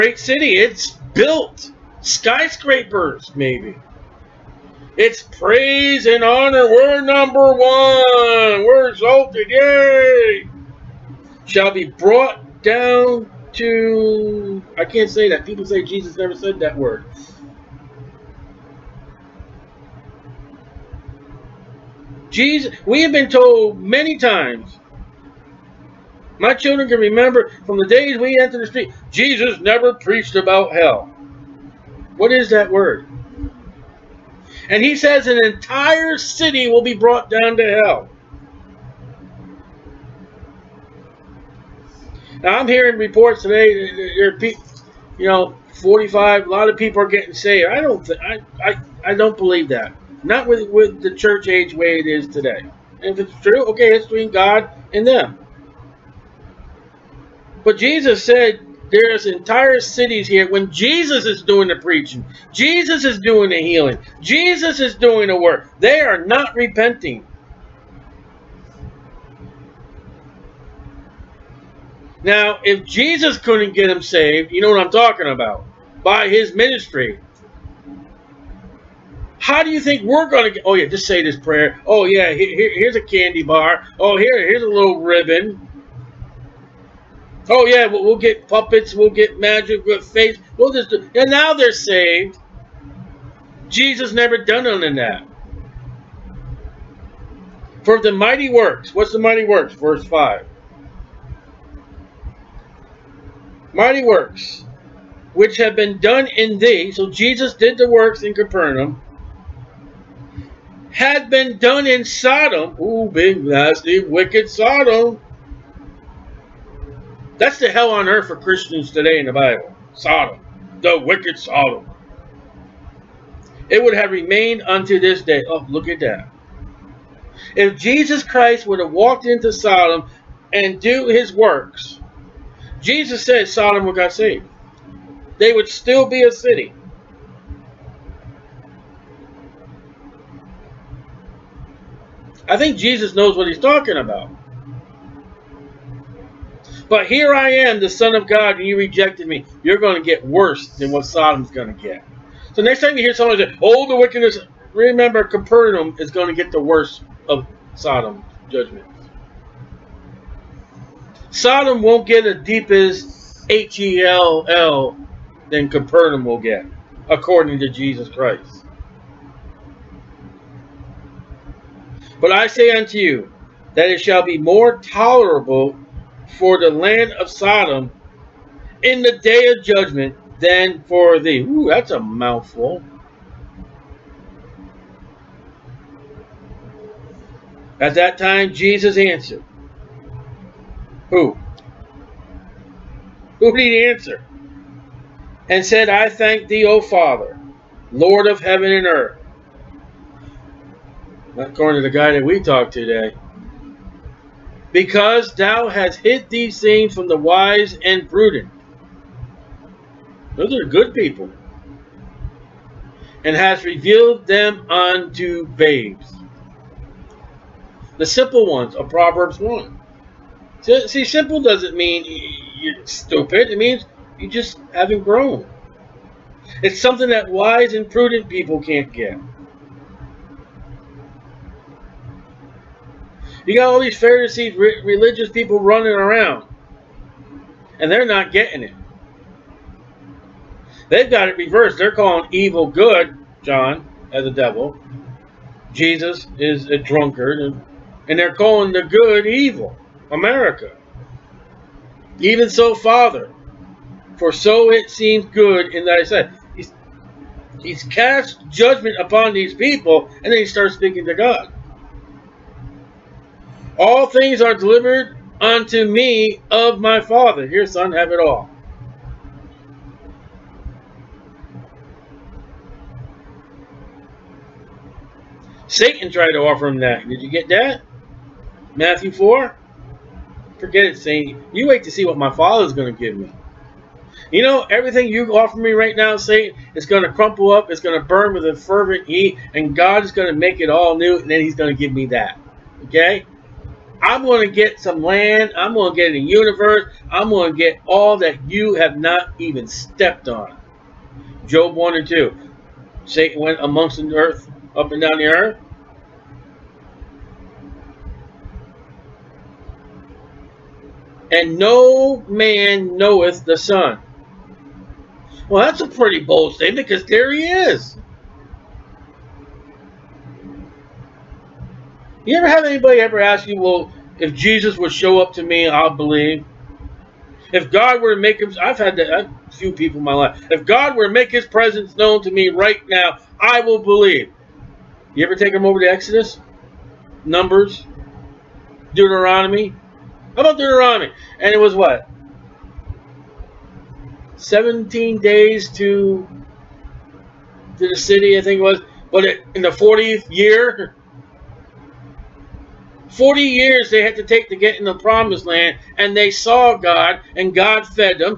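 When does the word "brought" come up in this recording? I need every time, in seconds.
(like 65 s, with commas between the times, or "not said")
11 s, 36 s.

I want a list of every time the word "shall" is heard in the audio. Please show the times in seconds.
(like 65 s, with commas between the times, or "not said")
11 s, 174 s.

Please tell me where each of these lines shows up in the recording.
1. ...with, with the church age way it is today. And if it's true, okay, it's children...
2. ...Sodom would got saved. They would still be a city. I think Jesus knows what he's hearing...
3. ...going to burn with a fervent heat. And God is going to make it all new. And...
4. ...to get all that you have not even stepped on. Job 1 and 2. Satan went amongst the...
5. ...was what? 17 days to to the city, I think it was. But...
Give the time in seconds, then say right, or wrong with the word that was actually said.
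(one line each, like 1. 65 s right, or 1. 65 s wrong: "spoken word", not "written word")
1. 50 s wrong: "between", not "children"
2. 133 s wrong: "talking", not "hearing"
3. 287 s right
4. 297 s right
5. 341 s right.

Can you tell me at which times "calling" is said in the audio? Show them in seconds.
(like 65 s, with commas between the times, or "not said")
241 s, 248 s.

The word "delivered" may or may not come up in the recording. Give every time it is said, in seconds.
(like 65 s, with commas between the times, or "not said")
264 s.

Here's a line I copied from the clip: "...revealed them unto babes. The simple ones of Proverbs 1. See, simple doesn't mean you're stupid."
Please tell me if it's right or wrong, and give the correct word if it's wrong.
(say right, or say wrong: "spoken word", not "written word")
right.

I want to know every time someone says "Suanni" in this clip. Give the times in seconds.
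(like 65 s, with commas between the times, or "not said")
not said.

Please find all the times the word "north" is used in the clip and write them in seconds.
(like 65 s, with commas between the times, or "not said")
not said.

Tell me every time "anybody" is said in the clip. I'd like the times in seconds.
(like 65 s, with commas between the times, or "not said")
322 s.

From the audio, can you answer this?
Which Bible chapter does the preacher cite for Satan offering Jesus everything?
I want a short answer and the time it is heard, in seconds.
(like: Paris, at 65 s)
Matthew 4, at 278 s.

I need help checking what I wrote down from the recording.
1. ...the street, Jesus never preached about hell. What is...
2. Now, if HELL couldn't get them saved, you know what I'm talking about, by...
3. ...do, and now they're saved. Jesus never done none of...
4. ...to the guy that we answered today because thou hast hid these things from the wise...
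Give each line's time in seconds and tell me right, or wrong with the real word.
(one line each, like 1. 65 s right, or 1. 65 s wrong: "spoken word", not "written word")
1. 28 s right
2. 72 s wrong: "Jesus", not "HELL"
3. 90 s right
4. 201 s wrong: "talked", not "answered".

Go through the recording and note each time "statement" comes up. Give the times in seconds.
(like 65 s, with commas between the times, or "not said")
316 s.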